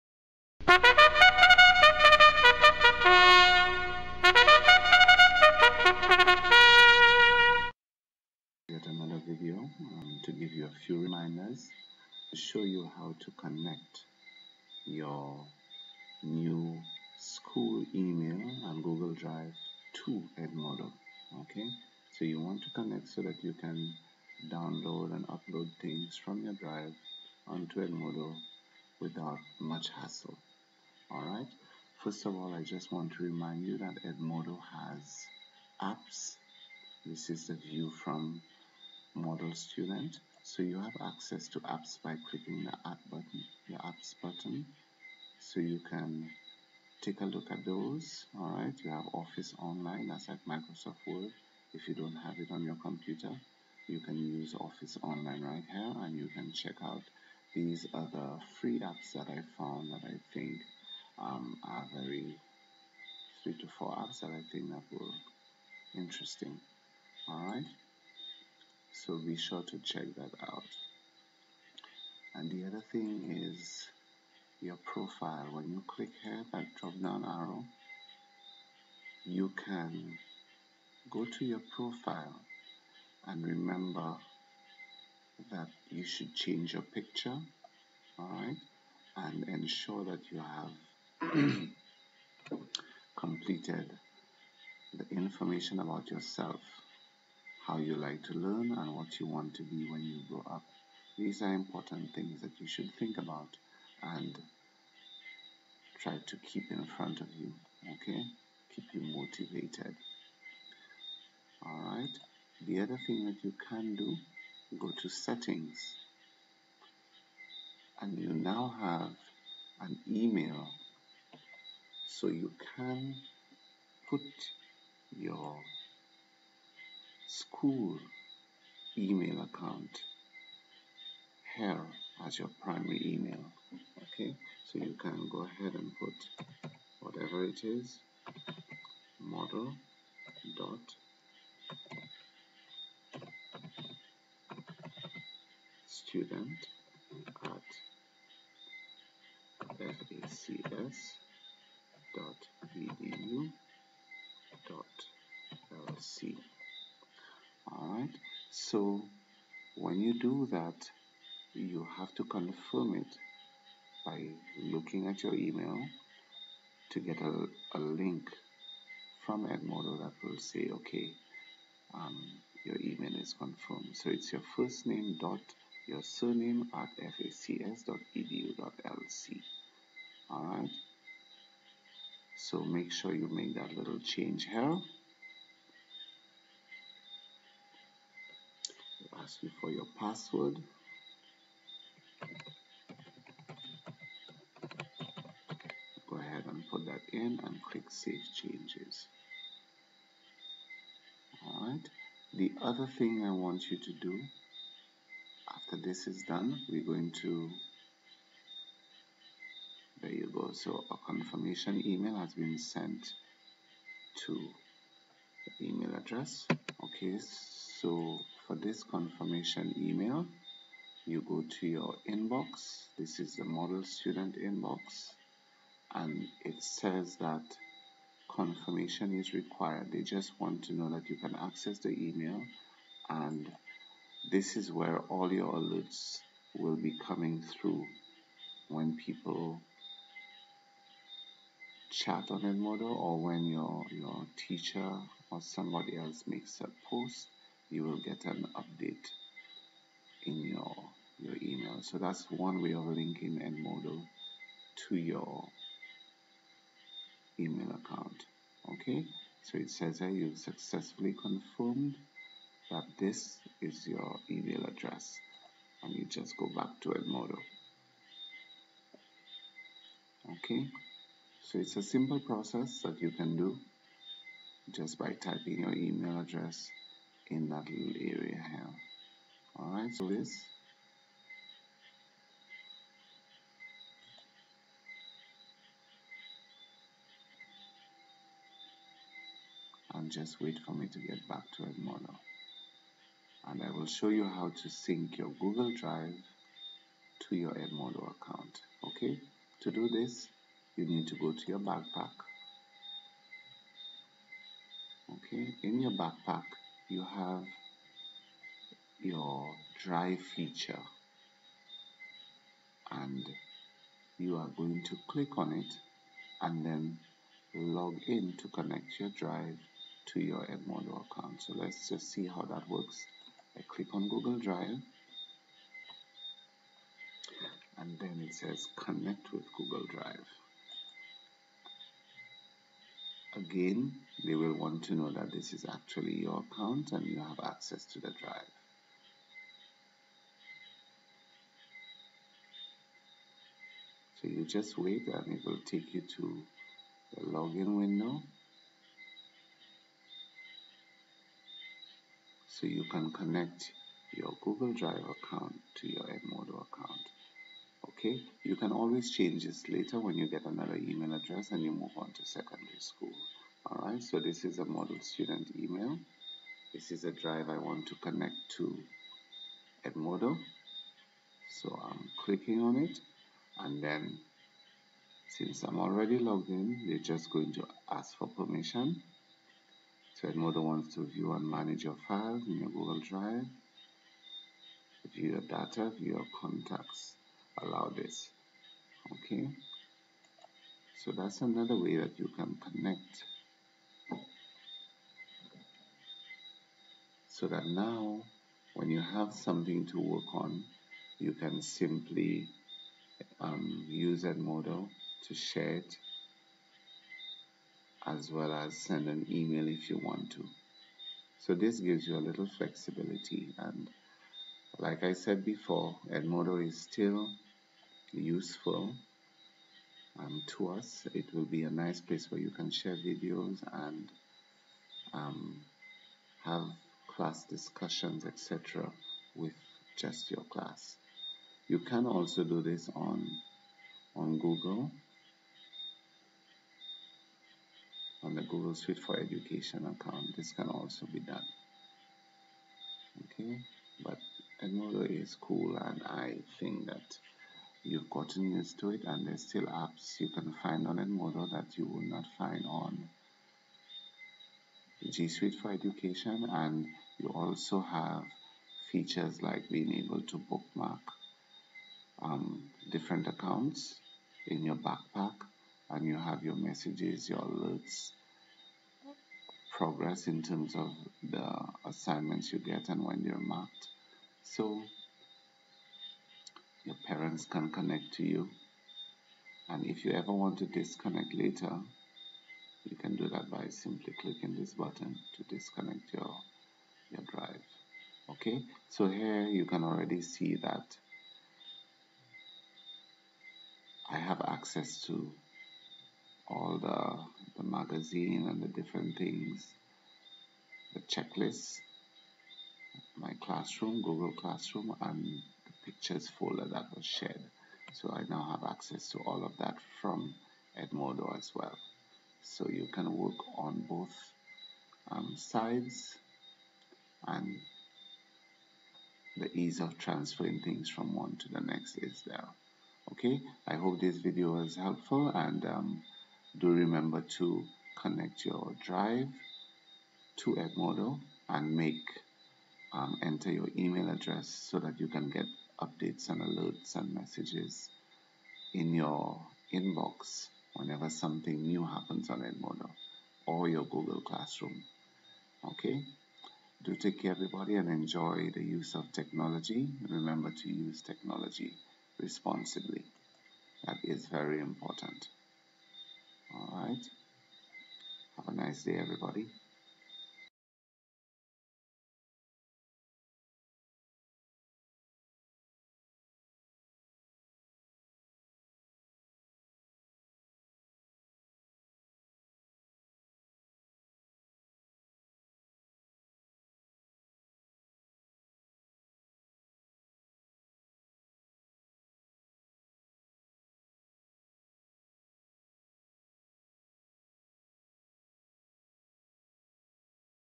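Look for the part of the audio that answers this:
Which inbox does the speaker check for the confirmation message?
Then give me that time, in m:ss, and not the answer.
3:43.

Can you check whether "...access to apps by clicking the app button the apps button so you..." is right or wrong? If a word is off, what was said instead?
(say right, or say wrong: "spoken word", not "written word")
right.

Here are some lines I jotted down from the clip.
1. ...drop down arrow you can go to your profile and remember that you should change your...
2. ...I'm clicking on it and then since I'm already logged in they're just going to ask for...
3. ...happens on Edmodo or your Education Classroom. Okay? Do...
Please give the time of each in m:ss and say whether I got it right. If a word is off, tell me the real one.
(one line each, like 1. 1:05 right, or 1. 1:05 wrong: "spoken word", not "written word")
1. 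1:16 right
2. 6:11 right
3. 9:01 wrong: "Google", not "Education".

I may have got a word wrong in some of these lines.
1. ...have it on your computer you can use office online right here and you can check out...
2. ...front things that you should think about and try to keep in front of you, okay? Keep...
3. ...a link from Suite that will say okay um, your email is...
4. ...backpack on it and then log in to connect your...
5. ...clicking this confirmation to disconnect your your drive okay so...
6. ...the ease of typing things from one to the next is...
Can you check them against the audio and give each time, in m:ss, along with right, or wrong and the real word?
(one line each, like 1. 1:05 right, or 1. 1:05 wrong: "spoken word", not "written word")
1. 0:52 right
2. 1:41 wrong: "important", not "front"
3. 2:47 wrong: "Edmodo", not "Suite"
4. 5:15 wrong: "click", not "backpack"
5. 8:04 wrong: "button", not "confirmation"
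6. 8:39 wrong: "transferring", not "typing".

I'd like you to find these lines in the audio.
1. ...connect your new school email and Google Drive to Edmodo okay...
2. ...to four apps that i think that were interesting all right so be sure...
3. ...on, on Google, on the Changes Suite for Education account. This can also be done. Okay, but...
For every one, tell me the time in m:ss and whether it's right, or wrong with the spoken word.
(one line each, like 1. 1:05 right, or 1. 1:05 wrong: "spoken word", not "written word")
1. 0:13 right
2. 1:03 right
3. 7:12 wrong: "Google", not "Changes".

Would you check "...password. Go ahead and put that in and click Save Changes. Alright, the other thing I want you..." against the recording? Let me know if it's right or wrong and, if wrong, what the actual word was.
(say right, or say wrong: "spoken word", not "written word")
right.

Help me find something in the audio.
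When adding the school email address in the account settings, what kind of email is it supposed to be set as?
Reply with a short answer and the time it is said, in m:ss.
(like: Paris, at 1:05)
Primary email, at 2:12.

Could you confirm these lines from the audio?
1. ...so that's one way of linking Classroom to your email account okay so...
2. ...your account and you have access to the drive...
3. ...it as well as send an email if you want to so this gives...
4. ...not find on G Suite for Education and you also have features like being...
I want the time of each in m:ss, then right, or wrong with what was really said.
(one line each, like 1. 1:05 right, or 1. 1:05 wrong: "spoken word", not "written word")
1. 4:11 wrong: "Edmodo", not "Classroom"
2. 5:36 right
3. 6:45 right
4. 7:32 right.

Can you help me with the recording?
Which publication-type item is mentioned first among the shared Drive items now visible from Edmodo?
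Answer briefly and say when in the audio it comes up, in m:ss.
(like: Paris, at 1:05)
Magazine, at 8:17.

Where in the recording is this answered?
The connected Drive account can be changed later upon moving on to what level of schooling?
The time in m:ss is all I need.
6:02.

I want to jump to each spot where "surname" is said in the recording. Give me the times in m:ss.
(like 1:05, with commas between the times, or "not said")
2:56.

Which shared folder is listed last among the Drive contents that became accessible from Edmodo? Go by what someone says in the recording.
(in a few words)
Pictures folder.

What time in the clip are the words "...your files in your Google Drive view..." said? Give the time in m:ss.
6:21.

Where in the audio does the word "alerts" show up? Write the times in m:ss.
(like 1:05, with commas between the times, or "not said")
3:55, 7:47, 8:56.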